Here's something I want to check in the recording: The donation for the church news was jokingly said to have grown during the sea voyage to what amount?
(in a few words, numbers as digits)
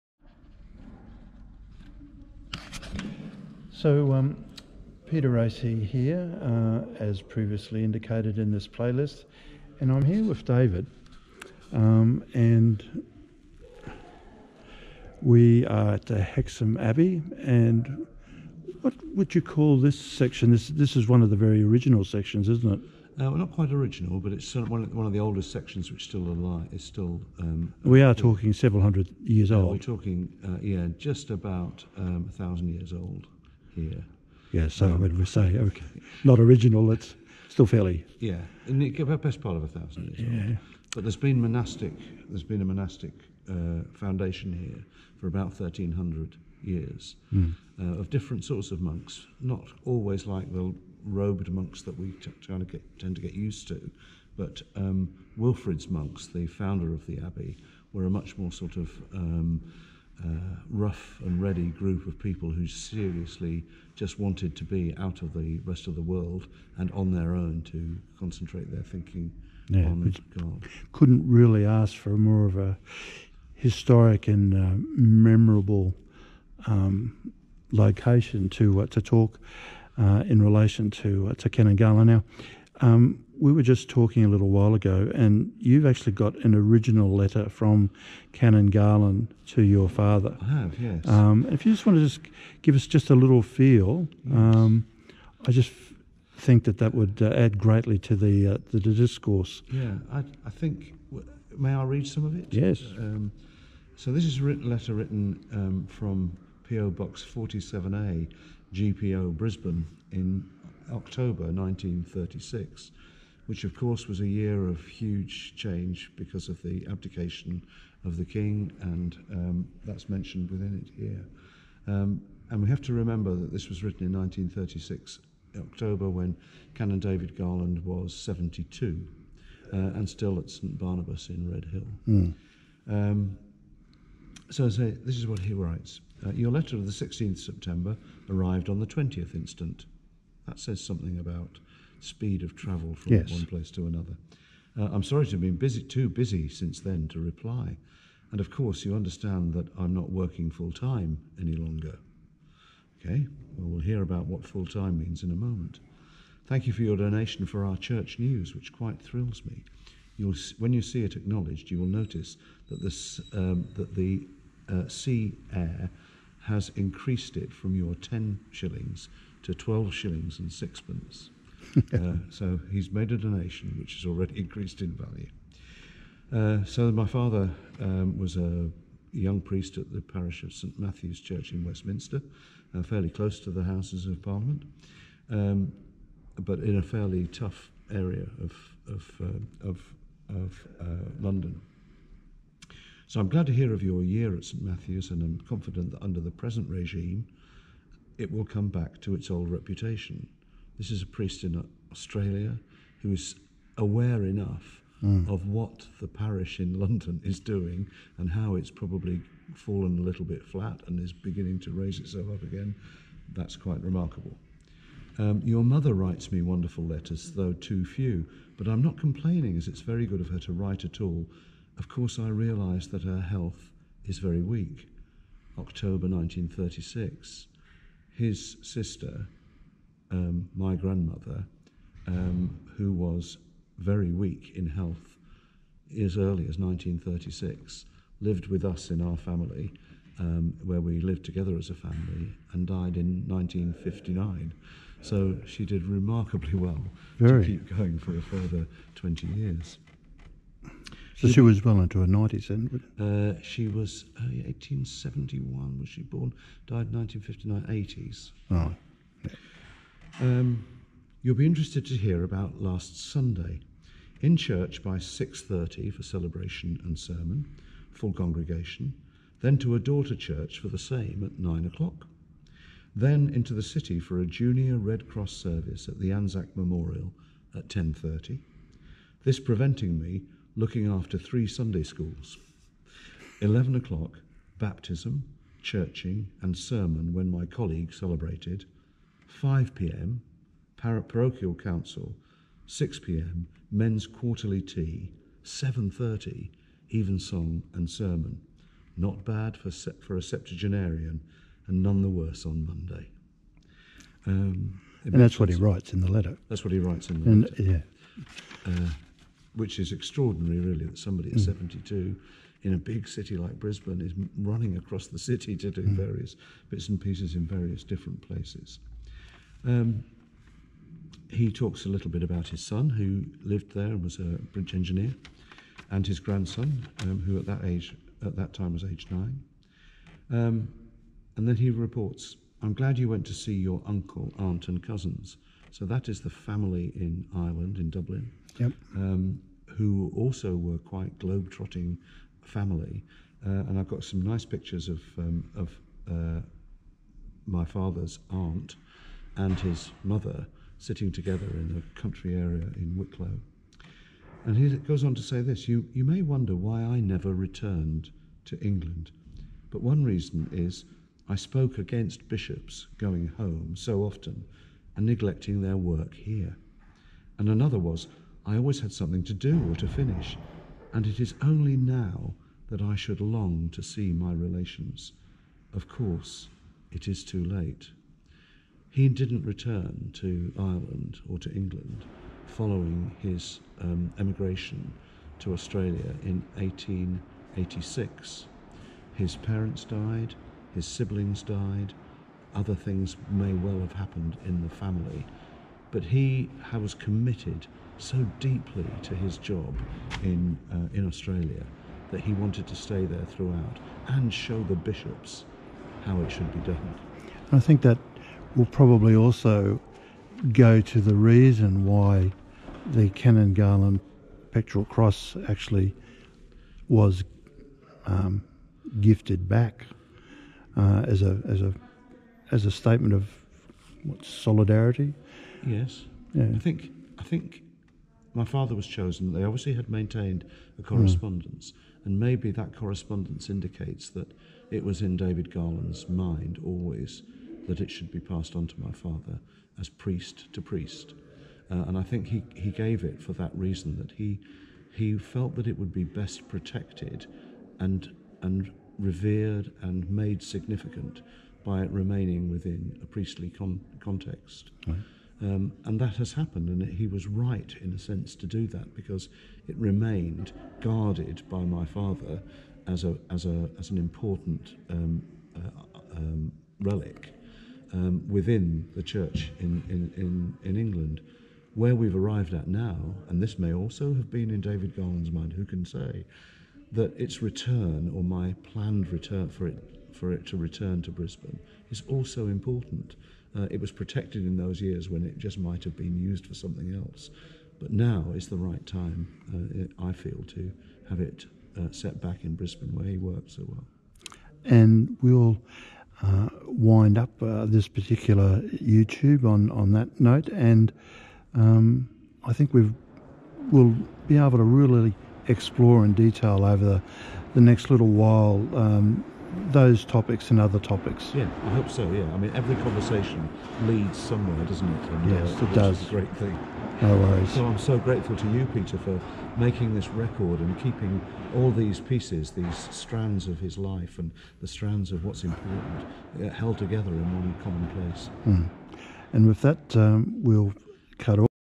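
12 shillings and sixpence.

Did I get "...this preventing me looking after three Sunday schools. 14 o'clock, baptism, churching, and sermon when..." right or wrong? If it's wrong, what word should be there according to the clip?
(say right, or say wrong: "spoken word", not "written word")
wrong: "11", not "14".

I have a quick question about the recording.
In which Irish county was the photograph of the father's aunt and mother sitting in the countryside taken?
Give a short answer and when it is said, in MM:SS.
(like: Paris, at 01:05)
Wicklow, at 05:52.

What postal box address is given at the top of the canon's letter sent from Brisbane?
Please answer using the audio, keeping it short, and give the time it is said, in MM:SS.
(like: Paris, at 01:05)
PO Box 47A, at 01:46.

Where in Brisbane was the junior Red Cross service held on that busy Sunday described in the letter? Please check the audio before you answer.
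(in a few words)
Anzac Memorial.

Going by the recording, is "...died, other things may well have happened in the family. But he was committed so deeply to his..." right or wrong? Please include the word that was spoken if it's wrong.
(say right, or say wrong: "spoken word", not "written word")
right.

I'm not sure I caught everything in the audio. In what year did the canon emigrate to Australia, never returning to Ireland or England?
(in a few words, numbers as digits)
1886.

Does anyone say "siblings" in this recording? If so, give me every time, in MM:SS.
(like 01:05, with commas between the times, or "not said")
06:30.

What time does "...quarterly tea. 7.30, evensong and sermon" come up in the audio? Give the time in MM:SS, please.
04:54.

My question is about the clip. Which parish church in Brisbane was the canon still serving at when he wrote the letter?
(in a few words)
St Barnabas.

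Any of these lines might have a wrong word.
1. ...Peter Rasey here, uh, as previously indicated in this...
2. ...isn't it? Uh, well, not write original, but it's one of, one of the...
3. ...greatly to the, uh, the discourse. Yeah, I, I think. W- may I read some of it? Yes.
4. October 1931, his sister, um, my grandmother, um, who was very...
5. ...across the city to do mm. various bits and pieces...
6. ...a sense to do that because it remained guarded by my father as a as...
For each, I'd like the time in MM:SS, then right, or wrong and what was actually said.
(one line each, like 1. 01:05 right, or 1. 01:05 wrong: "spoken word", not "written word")
1. 00:05 right
2. 00:22 wrong: "quite", not "write"
3. 01:37 right
4. 03:45 wrong: "1936", not "1931"
5. 05:14 right
6. 07:37 right.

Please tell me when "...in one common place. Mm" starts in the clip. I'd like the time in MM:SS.
08:47.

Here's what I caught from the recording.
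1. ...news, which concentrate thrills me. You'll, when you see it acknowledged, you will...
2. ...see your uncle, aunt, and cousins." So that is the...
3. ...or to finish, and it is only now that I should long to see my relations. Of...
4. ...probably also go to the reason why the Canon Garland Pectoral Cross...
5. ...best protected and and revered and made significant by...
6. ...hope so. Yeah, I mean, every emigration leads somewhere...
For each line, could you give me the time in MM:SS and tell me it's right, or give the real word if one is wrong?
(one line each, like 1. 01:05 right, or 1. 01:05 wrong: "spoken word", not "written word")
1. 02:38 wrong: "quite", not "concentrate"
2. 05:33 right
3. 06:09 right
4. 06:48 right
5. 07:26 right
6. 08:31 wrong: "conversation", not "emigration".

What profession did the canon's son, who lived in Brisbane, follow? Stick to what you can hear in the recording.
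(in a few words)
Bridge engineer.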